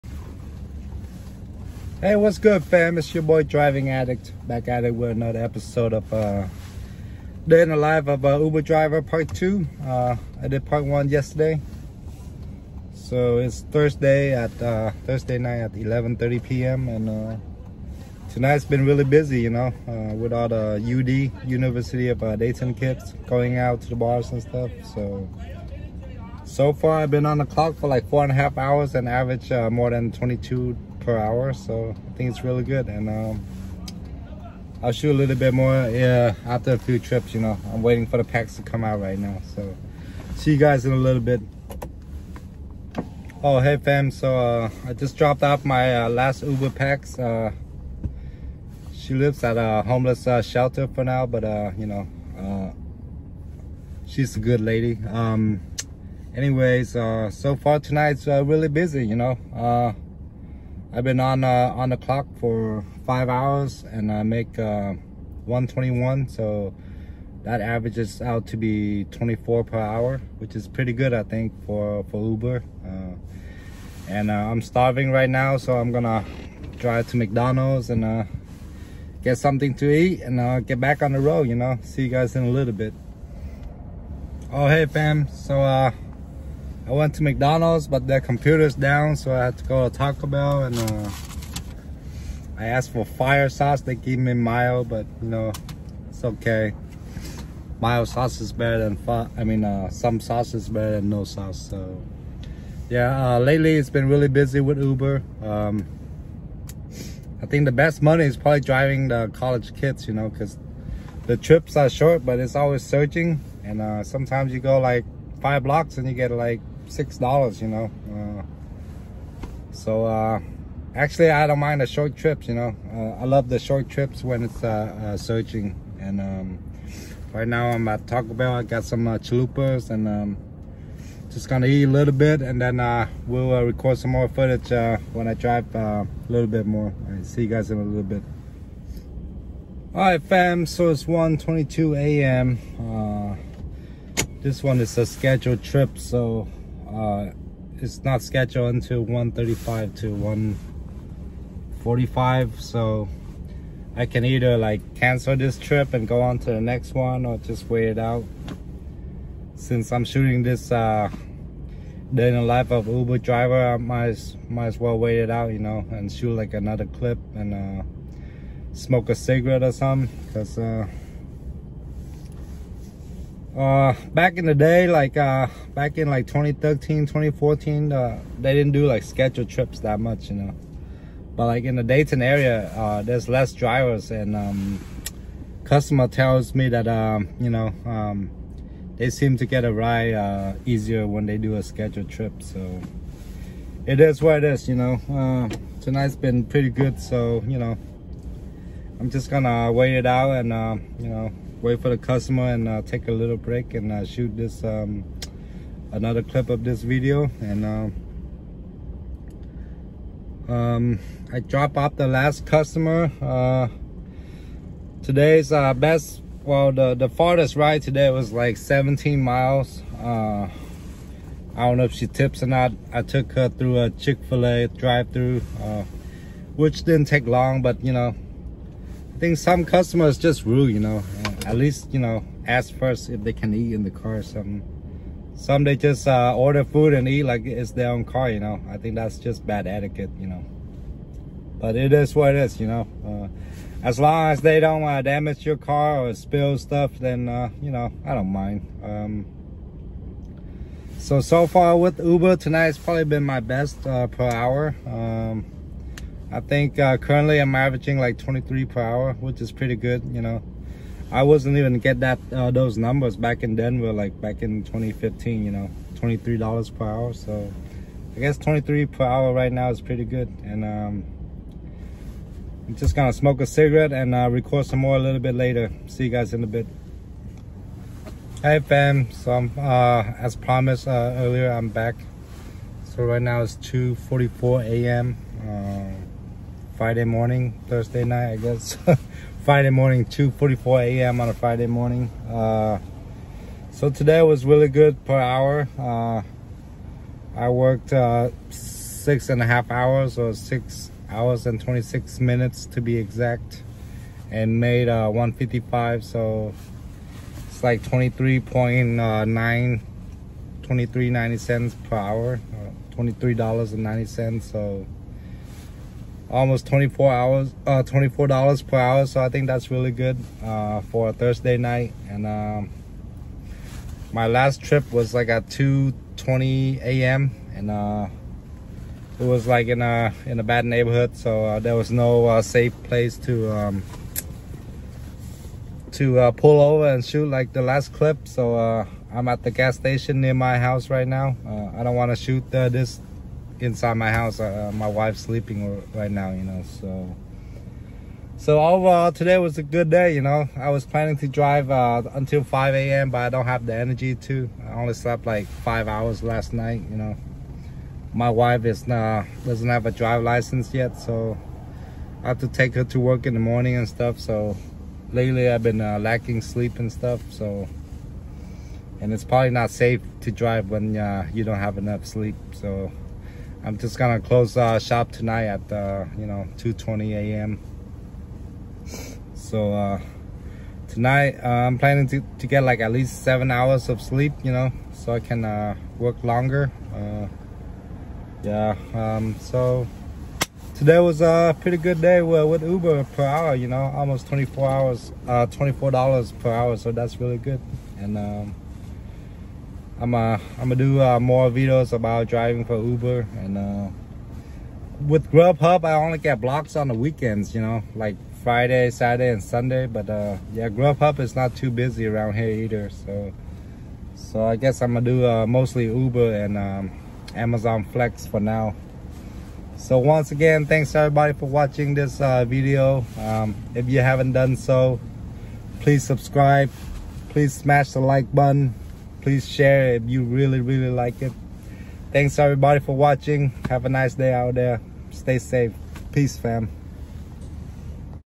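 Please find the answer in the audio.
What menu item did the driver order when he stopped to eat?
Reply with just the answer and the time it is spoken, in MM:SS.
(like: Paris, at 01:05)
Chalupas, at 02:09.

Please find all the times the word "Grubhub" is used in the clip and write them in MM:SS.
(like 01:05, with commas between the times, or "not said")
06:45, 06:50.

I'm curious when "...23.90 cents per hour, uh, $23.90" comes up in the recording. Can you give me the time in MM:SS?
05:10.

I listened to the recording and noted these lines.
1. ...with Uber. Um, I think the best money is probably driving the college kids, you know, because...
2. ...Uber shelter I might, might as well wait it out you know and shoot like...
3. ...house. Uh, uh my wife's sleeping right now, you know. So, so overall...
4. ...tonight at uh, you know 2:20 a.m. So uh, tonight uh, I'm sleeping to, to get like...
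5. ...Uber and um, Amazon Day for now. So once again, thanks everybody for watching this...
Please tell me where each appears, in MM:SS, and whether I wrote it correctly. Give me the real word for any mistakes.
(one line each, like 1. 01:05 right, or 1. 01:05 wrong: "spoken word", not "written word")
1. 01:44 right
2. 02:42 wrong: "driver", not "shelter"
3. 05:44 right
4. 06:15 wrong: "planning", not "sleeping"
5. 06:55 wrong: "Flex", not "Day".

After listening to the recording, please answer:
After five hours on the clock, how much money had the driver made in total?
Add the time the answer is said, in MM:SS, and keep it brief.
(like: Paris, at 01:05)
$121, at 01:05.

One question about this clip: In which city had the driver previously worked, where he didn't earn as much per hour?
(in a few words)
Denver.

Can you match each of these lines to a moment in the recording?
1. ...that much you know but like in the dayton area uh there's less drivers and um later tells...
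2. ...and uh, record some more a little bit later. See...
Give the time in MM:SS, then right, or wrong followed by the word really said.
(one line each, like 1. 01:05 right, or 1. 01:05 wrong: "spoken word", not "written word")
1. 02:59 wrong: "customer", not "later"
2. 04:33 right.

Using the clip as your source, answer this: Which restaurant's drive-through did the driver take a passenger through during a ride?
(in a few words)
Chick-fil-A.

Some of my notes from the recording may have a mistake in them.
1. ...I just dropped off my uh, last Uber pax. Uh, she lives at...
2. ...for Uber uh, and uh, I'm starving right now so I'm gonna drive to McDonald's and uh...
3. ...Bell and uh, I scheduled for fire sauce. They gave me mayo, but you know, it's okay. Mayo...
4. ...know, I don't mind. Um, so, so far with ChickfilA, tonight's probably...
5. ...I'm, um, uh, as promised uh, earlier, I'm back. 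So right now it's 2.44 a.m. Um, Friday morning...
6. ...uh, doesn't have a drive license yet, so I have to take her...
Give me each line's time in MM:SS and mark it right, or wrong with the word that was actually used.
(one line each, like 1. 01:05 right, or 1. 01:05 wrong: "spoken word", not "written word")
1. 00:44 right
2. 01:12 right
3. 01:30 wrong: "asked", not "scheduled"
4. 04:07 wrong: "Uber", not "ChickfilA"
5. 04:39 right
6. 05:58 right.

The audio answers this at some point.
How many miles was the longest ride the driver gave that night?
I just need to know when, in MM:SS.
03:38.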